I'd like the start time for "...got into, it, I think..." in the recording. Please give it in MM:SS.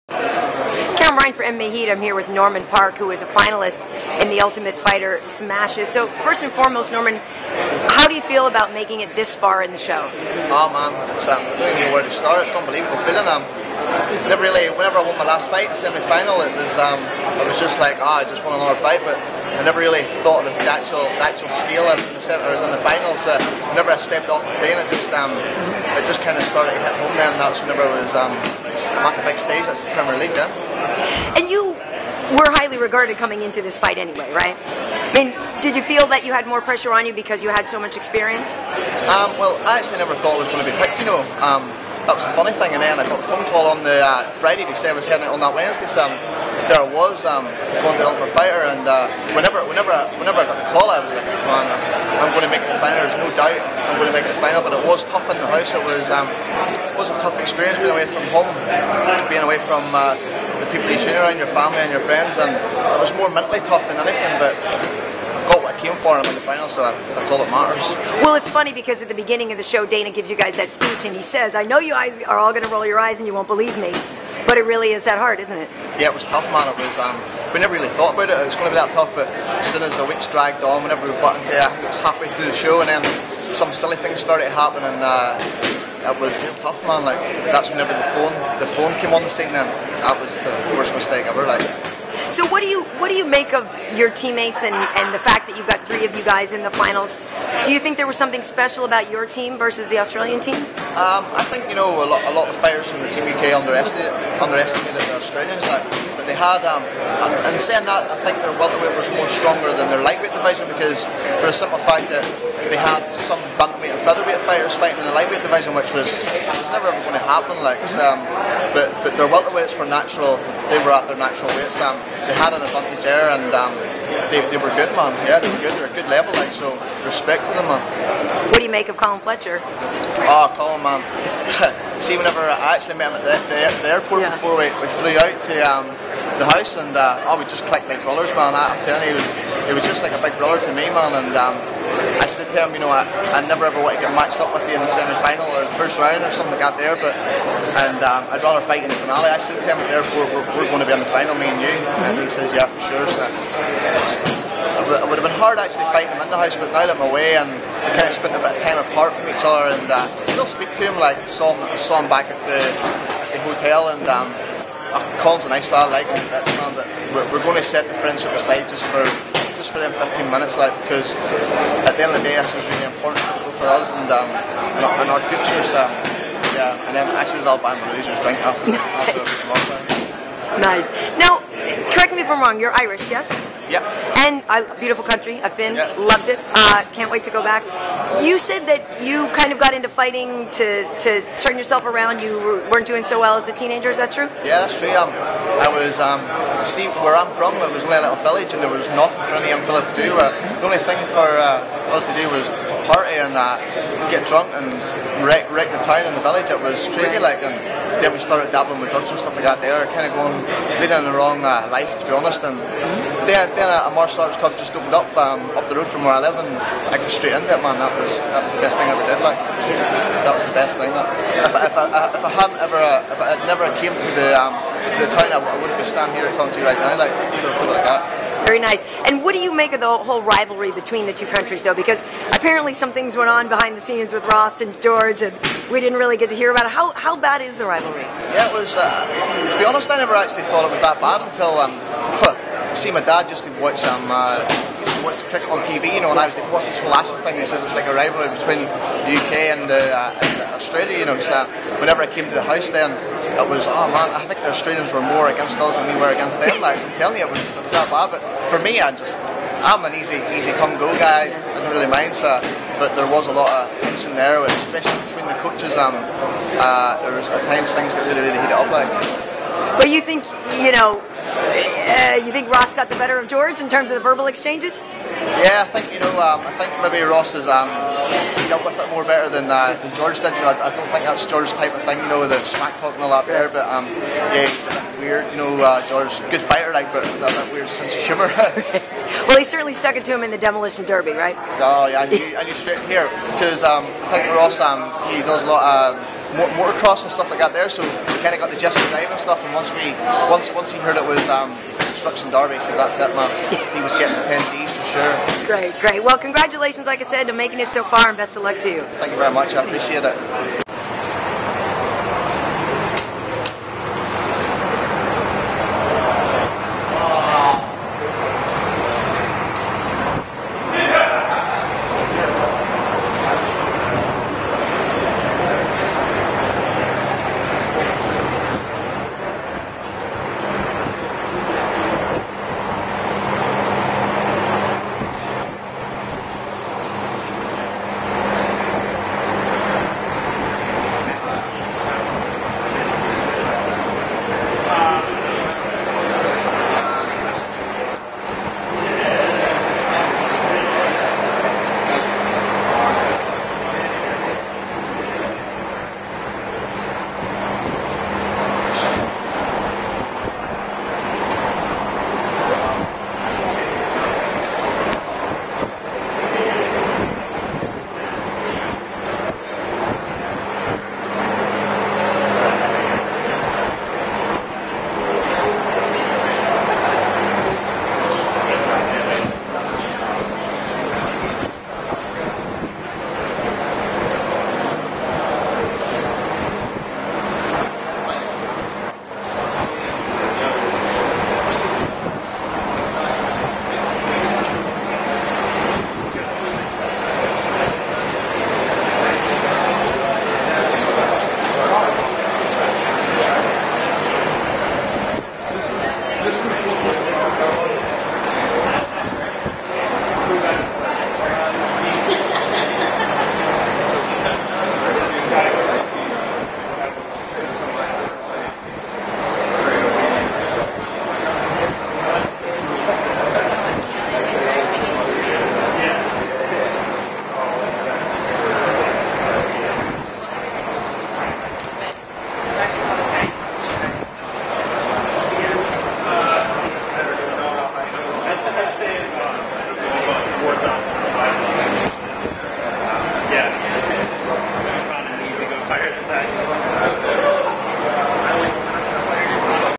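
01:21.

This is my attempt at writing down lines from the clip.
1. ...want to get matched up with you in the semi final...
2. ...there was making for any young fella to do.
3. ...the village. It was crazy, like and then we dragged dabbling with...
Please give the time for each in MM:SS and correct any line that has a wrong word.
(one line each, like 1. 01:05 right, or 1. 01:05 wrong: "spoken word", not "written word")
1. 02:23 right
2. 03:18 wrong: "nothing", not "making"
3. 03:26 wrong: "started", not "dragged".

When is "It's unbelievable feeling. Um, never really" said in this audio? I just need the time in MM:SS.
00:12.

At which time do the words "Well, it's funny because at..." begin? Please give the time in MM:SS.
01:08.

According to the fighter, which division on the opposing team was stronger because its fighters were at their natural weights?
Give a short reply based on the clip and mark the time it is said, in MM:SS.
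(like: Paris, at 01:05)
Welterweight, at 01:48.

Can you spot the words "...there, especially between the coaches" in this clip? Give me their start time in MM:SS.
04:24.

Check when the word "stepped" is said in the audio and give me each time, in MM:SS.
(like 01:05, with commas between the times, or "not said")
00:24.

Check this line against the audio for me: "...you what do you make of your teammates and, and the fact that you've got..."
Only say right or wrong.
right.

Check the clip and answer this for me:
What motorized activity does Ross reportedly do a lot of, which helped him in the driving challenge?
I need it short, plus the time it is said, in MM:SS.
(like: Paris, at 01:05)
Motocross, at 04:56.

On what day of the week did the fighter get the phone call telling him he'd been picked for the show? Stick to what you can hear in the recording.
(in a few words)
Friday.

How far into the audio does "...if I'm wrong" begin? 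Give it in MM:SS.
03:02.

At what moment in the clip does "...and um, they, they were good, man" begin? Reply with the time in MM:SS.
02:03.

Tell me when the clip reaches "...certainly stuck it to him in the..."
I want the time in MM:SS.
04:49.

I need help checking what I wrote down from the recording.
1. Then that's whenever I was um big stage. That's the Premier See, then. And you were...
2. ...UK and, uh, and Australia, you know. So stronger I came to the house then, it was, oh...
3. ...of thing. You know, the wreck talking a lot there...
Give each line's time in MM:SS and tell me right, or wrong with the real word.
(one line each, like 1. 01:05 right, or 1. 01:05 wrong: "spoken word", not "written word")
1. 00:27 wrong: "League", not "See"
2. 04:09 wrong: "whenever", not "stronger"
3. 04:41 wrong: "smack", not "wreck".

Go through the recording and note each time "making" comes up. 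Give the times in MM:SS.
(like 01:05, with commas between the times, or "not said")
00:08, 05:07.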